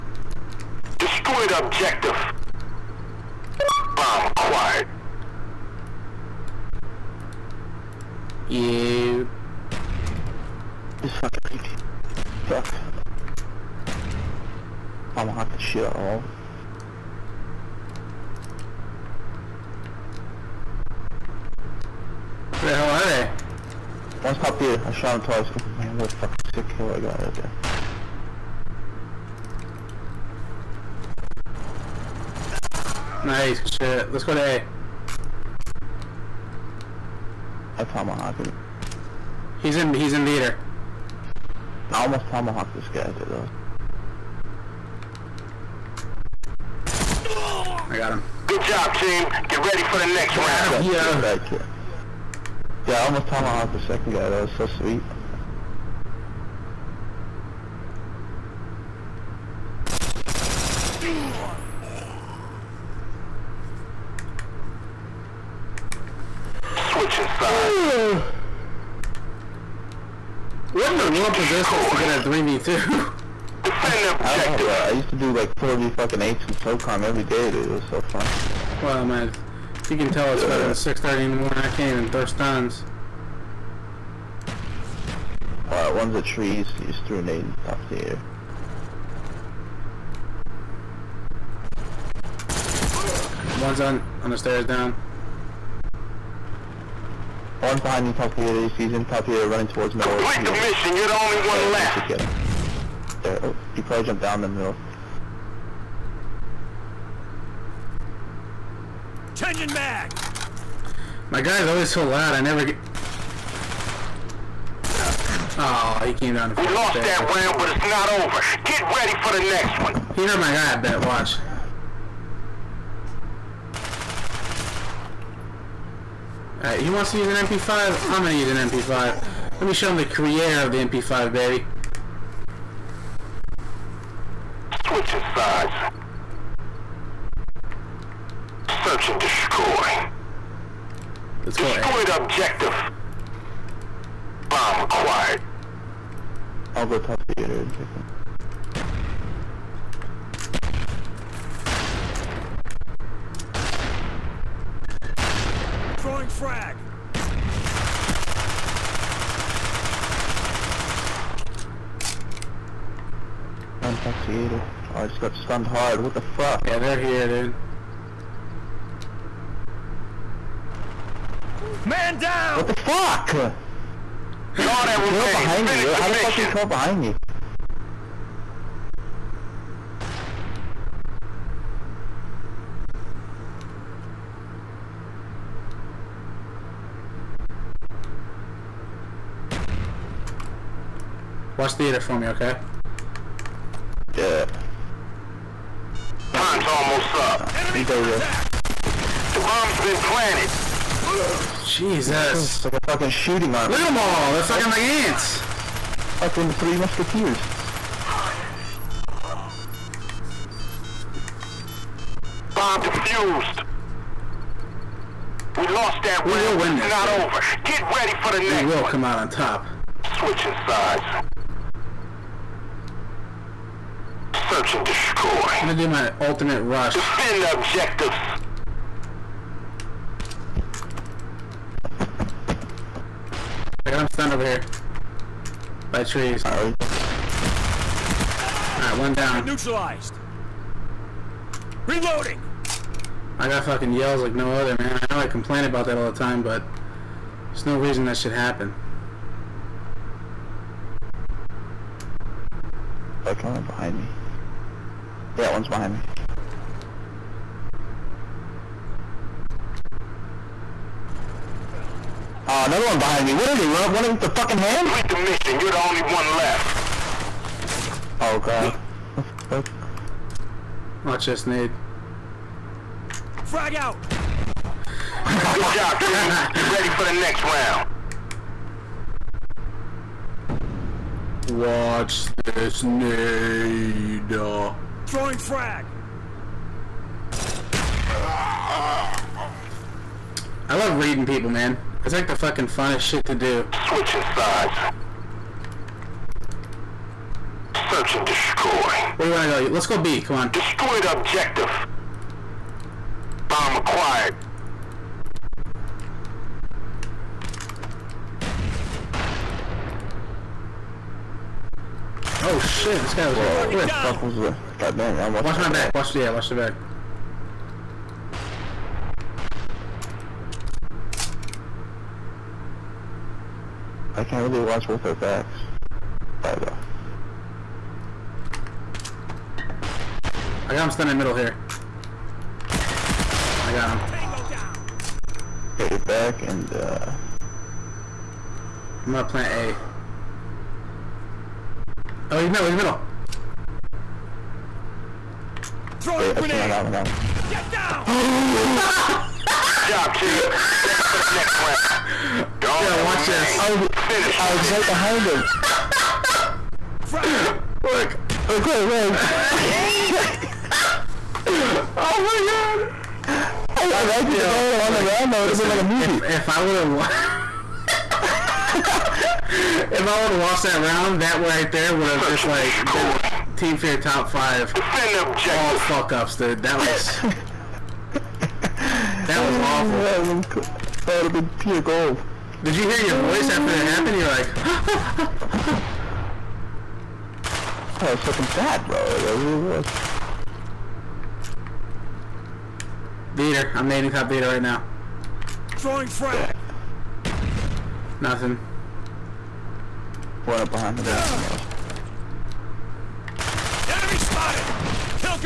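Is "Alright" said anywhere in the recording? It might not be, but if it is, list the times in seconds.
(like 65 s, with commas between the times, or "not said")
126 s, 236 s, 326 s.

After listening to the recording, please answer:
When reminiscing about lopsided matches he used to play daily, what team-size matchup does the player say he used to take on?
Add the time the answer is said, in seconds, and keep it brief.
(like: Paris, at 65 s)
4v8, at 75 s.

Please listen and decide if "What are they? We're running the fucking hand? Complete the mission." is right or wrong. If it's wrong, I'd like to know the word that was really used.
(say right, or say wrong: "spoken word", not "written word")
right.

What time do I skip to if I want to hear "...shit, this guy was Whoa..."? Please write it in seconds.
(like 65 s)
312 s.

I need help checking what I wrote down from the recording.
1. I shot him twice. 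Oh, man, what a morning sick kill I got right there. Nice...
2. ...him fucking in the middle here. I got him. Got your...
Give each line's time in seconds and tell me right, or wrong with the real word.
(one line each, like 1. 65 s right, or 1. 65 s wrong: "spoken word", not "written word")
1. 24 s wrong: "fucking", not "morning"
2. 330 s wrong: "standing", not "fucking".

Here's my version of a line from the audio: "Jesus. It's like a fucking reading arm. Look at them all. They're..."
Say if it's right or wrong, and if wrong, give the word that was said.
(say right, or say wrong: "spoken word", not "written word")
wrong: "shooting", not "reading".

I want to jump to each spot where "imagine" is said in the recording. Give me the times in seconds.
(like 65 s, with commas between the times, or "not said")
364 s.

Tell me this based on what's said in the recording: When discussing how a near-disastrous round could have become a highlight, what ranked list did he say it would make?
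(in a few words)
top five.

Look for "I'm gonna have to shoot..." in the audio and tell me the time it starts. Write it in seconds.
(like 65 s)
15 s.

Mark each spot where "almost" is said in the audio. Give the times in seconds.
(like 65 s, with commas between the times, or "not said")
41 s, 52 s, 196 s.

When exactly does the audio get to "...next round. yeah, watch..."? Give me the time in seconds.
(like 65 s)
351 s.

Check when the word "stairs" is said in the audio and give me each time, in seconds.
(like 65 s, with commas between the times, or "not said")
94 s, 116 s.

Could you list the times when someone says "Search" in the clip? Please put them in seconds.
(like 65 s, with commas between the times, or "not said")
138 s, 224 s, 297 s.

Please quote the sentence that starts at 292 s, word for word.
It's like the fucking funnest shit to do.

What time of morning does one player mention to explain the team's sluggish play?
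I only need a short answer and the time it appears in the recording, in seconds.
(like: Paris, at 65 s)
6:30, at 80 s.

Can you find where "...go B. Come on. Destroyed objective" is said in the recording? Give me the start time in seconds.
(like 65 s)
299 s.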